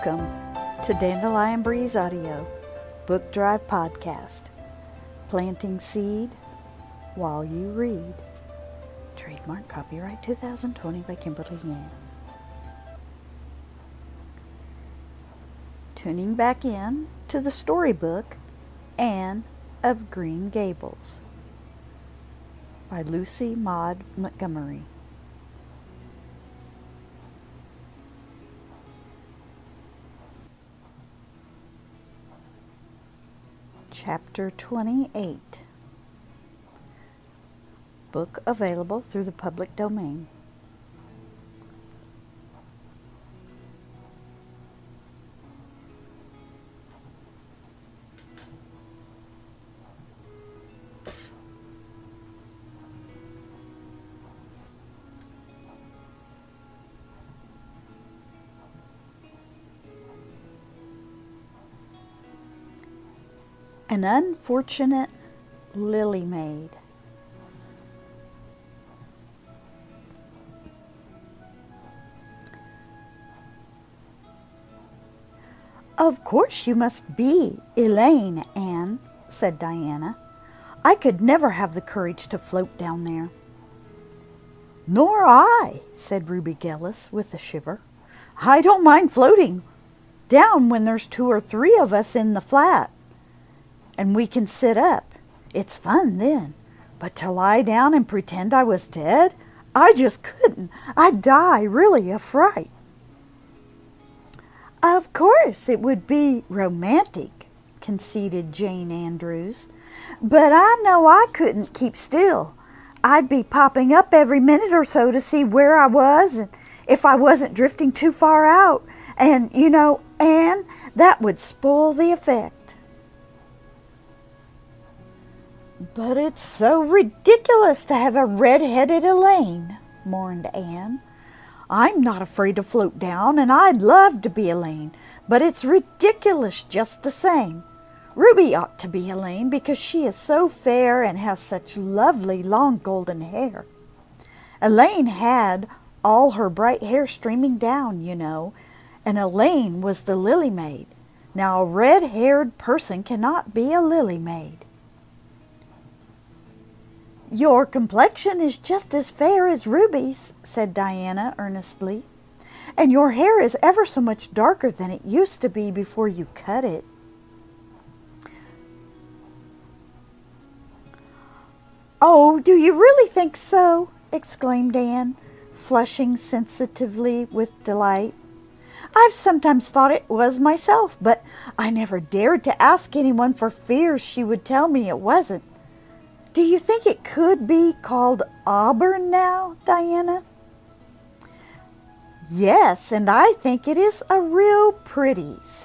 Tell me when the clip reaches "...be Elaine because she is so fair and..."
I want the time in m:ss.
2:18.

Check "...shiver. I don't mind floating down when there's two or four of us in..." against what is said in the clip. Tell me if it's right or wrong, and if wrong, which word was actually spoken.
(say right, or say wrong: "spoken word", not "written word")
wrong: "three", not "four".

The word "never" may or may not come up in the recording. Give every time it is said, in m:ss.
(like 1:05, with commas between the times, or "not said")
1:21, 3:01.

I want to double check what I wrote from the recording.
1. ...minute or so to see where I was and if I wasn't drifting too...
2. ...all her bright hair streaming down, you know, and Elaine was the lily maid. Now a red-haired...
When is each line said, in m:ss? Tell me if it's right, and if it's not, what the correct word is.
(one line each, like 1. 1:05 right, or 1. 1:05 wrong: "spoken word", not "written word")
1. 1:54 right
2. 2:26 right.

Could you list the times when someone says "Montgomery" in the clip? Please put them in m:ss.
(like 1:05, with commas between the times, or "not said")
0:24.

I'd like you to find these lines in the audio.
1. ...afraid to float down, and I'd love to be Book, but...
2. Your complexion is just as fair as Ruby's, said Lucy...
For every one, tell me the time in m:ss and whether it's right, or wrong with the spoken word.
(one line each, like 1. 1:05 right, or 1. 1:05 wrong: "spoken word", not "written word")
1. 2:12 wrong: "Elaine", not "Book"
2. 2:37 wrong: "Diana", not "Lucy".